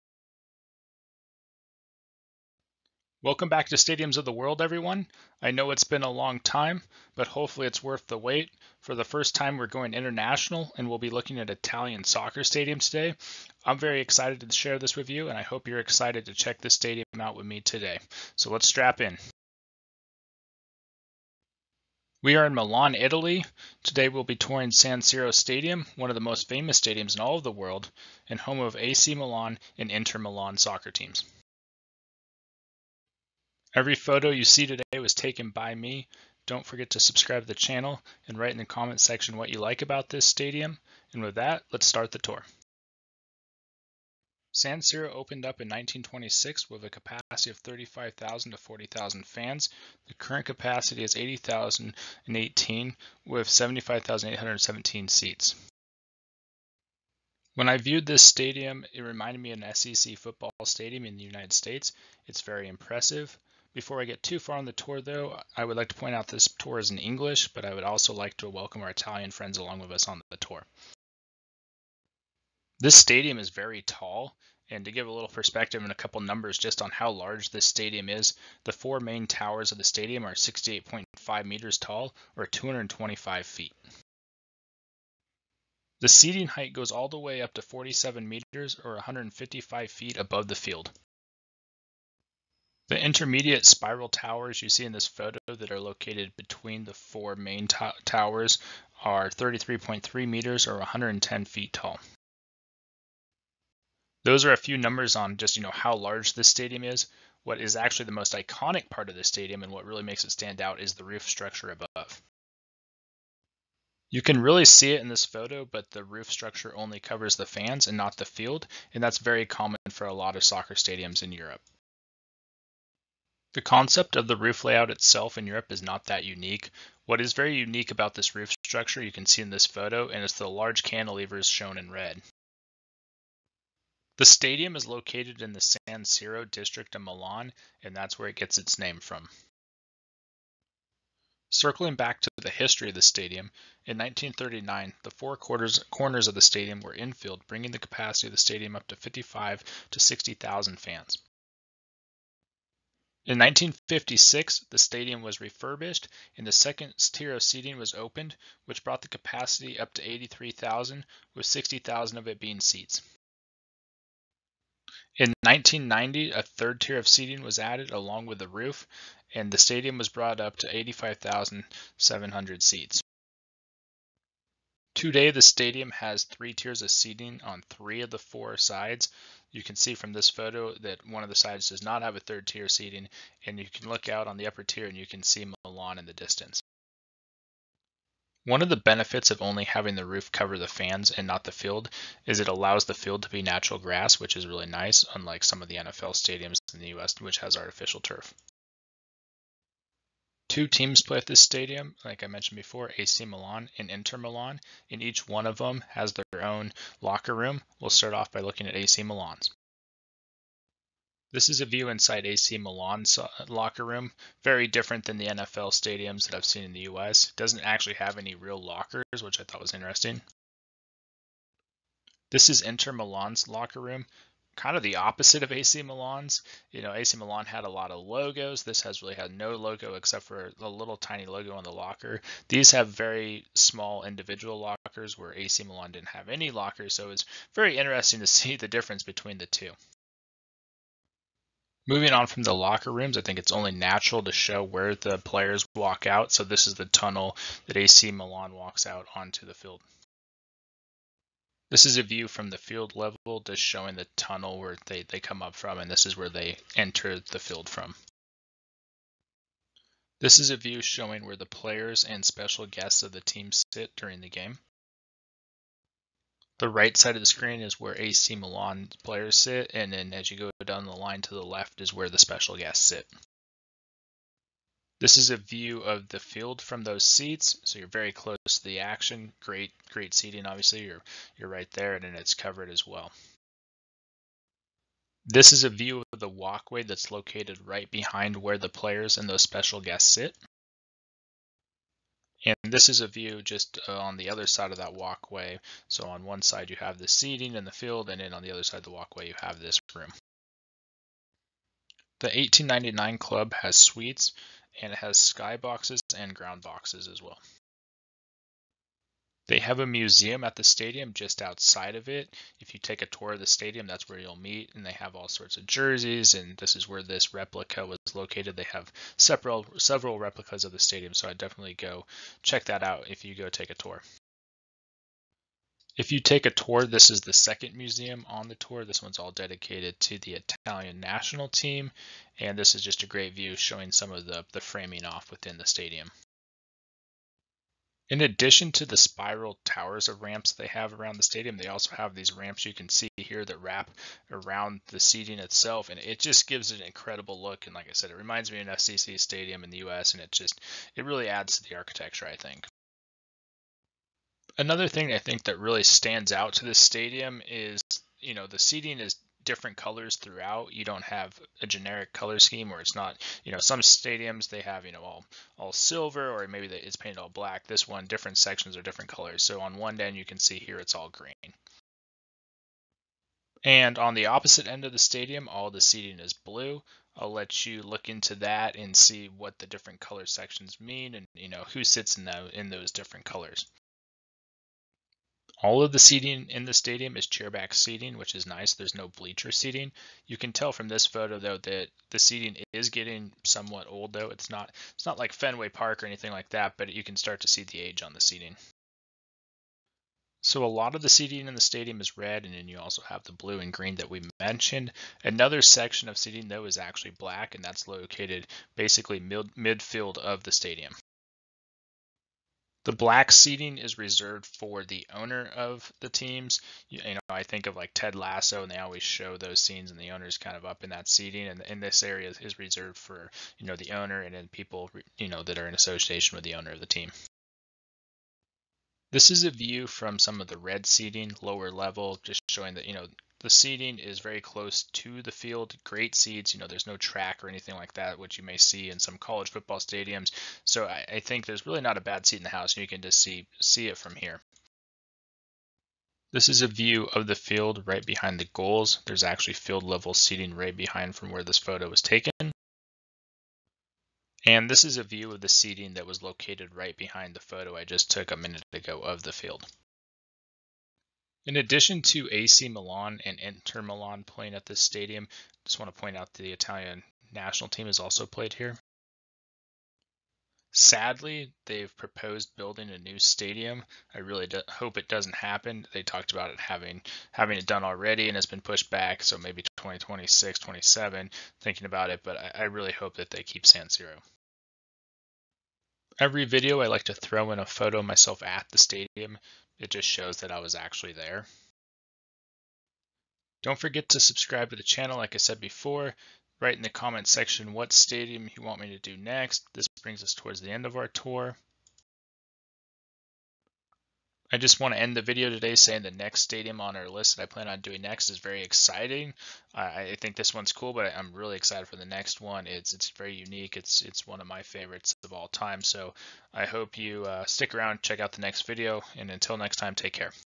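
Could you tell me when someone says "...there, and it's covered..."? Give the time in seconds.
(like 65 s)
281 s.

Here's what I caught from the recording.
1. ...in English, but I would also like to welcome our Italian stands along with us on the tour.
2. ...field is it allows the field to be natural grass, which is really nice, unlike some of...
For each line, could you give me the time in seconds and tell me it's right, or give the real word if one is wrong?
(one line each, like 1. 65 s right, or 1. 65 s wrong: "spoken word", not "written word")
1. 66 s wrong: "friends", not "stands"
2. 191 s right.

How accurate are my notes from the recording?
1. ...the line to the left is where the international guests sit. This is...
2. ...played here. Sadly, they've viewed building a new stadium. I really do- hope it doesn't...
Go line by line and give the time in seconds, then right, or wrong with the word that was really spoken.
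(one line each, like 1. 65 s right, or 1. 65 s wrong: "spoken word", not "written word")
1. 270 s wrong: "special", not "international"
2. 468 s wrong: "proposed", not "viewed".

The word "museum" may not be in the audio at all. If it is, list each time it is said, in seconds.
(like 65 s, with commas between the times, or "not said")
309 s, 327 s.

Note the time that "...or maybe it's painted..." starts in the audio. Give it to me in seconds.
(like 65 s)
366 s.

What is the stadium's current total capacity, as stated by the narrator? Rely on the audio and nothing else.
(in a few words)
80,018.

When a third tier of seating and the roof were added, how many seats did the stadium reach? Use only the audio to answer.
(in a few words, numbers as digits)
85,700.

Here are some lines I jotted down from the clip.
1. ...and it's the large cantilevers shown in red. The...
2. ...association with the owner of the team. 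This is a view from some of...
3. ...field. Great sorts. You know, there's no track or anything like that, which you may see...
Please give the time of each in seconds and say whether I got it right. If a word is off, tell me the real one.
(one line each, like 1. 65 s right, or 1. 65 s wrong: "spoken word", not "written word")
1. 130 s right
2. 425 s right
3. 435 s wrong: "seats", not "sorts".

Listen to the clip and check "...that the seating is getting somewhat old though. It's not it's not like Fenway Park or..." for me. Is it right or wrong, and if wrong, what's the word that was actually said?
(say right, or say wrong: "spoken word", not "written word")
right.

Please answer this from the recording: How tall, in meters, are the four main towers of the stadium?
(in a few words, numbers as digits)
68.5 meters.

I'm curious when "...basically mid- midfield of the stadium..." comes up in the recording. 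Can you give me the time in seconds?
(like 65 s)
408 s.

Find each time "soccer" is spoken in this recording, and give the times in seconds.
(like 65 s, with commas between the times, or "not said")
12 s, 30 s, 120 s.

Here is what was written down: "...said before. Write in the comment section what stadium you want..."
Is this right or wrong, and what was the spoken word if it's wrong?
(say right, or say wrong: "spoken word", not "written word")
right.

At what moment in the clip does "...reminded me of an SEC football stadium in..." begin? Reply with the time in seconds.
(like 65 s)
59 s.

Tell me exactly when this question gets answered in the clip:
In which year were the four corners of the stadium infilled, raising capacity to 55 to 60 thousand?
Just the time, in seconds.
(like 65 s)
143 s.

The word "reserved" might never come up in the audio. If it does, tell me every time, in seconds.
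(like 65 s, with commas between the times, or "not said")
413 s, 422 s.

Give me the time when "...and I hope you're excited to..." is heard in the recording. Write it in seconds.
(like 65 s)
15 s.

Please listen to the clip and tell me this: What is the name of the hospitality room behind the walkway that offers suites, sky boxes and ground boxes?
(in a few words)
1899 Club.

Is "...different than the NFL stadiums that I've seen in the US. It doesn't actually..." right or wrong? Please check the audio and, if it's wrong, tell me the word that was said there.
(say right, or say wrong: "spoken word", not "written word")
right.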